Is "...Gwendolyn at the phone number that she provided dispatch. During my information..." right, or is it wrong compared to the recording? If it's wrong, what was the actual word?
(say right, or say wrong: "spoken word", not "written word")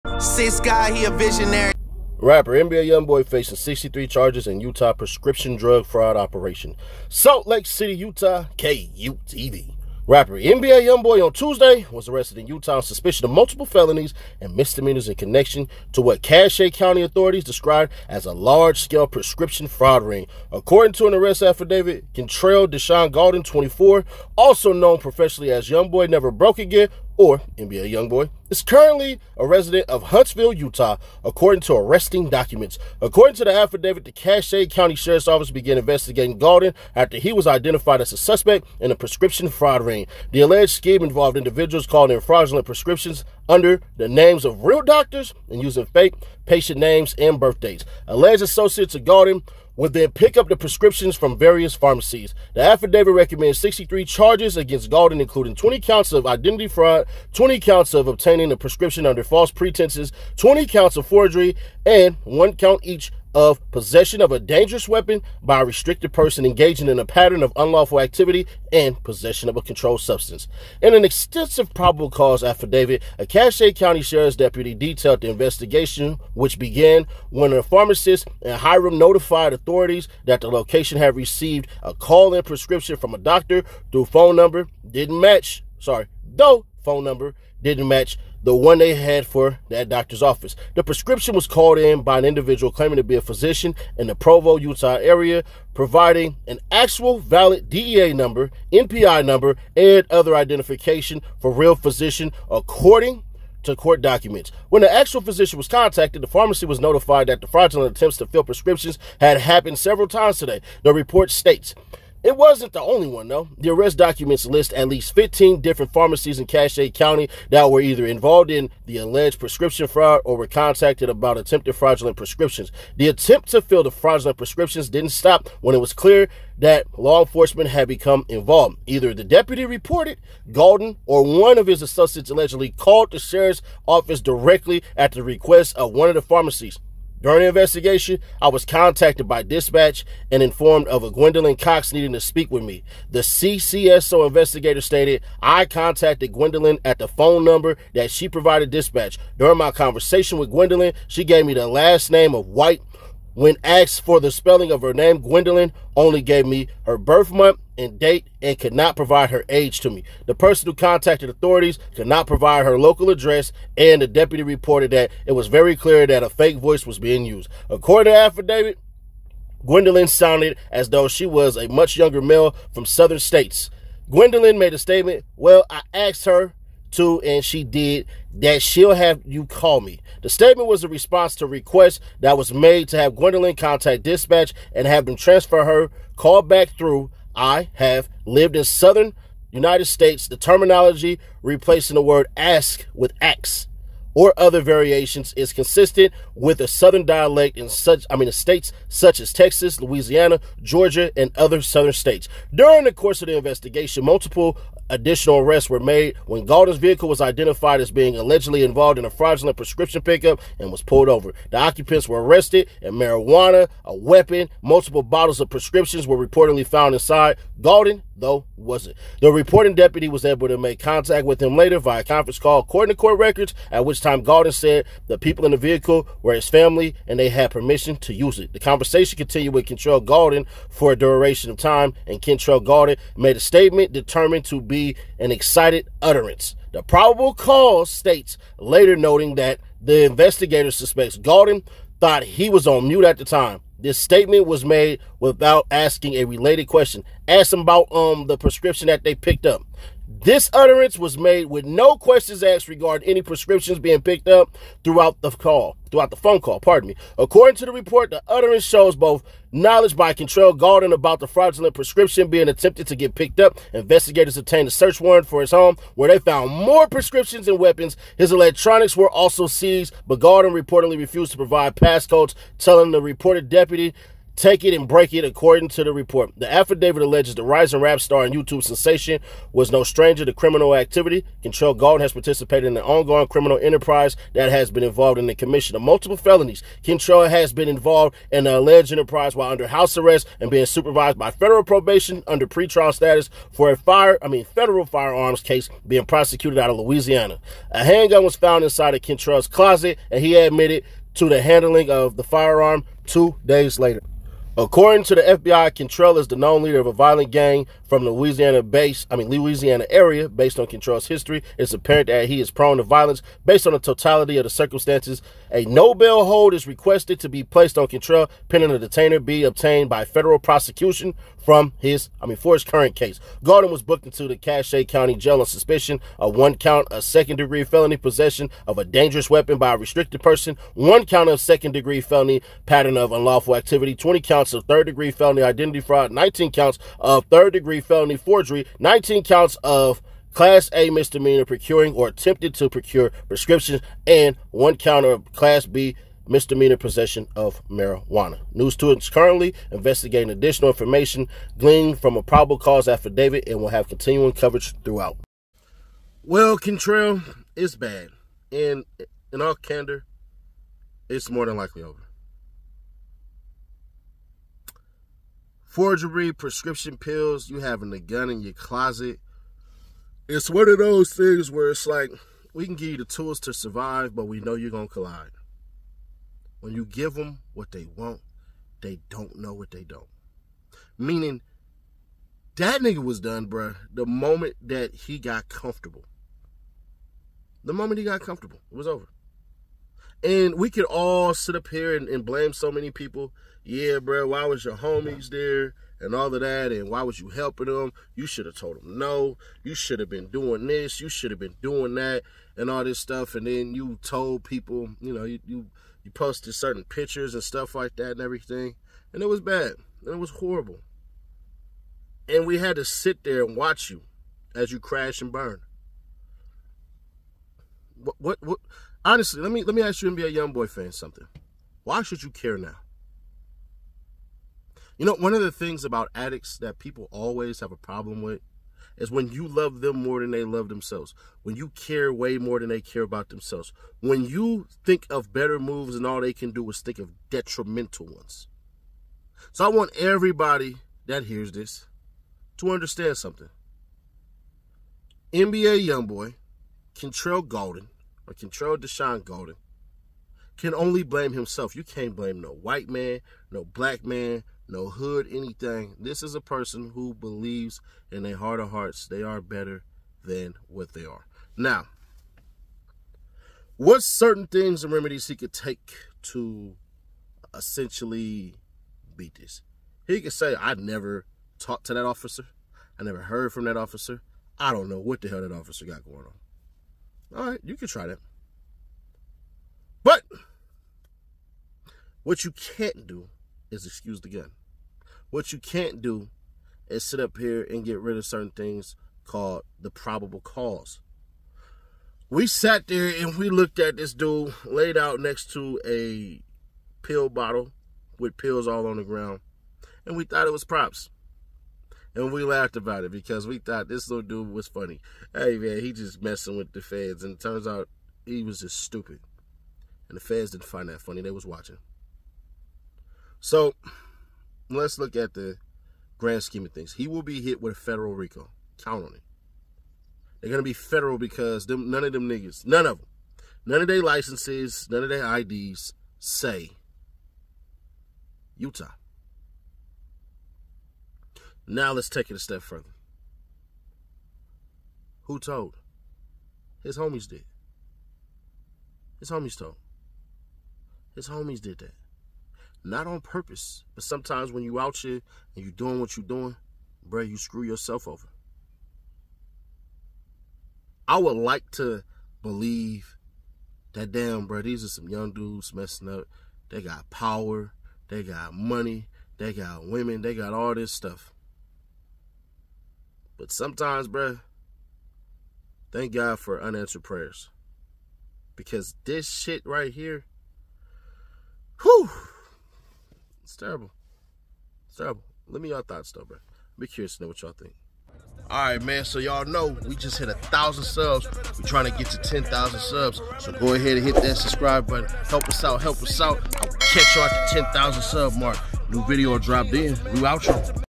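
wrong: "conversation", not "information".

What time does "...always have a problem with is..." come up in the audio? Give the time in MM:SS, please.
07:07.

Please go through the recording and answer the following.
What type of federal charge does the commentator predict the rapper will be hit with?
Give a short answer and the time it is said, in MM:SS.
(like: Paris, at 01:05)
RICO, at 08:38.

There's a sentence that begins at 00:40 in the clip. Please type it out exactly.
The alleged scheme involved individuals calling in fraudulent prescriptions under the names of real doctors and using fake patient names and birthdays.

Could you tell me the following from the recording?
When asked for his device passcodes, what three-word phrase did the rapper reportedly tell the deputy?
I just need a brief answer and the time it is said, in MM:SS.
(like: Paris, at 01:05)
Take it and break it, at 04:34.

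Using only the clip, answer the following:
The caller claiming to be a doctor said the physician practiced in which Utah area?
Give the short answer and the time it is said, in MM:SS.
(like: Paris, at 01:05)
Provo, at 01:34.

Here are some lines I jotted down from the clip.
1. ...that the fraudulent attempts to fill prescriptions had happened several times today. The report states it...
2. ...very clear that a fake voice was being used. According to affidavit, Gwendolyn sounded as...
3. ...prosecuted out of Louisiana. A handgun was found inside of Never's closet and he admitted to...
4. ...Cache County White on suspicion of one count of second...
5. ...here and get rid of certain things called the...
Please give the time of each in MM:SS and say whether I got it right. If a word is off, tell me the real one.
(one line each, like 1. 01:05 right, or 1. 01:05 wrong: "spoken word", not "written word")
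1. 01:47 right
2. 02:45 right
3. 04:56 wrong: "Control", not "Never"
4. 05:24 wrong: "Jail", not "White"
5. 08:07 right.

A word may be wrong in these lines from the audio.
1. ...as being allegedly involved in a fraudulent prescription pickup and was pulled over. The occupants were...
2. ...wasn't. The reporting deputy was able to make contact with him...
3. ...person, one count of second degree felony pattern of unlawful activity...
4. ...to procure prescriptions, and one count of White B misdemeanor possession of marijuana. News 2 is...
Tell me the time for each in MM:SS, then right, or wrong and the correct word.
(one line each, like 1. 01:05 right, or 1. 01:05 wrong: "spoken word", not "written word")
1. 03:27 right
2. 03:38 right
3. 05:30 right
4. 05:42 wrong: "Class", not "White".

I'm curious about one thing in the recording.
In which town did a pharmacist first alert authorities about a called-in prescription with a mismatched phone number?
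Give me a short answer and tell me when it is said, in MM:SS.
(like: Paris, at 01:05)
Hyrum, at 01:18.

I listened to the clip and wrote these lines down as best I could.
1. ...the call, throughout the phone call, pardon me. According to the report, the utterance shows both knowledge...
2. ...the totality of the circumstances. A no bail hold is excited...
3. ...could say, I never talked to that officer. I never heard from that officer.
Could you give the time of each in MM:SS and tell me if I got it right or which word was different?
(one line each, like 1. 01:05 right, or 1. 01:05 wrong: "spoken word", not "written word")
1. 04:15 right
2. 05:13 wrong: "requested", not "excited"
3. 07:50 right.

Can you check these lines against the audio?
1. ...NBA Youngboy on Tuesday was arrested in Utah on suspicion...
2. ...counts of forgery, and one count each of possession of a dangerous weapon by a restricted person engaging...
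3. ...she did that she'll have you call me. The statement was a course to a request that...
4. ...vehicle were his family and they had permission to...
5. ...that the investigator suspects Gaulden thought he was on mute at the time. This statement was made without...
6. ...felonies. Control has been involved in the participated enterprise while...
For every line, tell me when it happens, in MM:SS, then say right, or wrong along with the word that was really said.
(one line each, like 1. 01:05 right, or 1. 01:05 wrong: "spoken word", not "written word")
1. 00:10 right
2. 01:00 right
3. 02:57 wrong: "response", not "course"
4. 03:45 right
5. 03:59 right
6. 04:46 wrong: "alleged", not "participated".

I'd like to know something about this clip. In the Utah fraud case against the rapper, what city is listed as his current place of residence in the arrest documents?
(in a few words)
Huntsville.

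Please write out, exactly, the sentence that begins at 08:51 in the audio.
Now let's take it a step further.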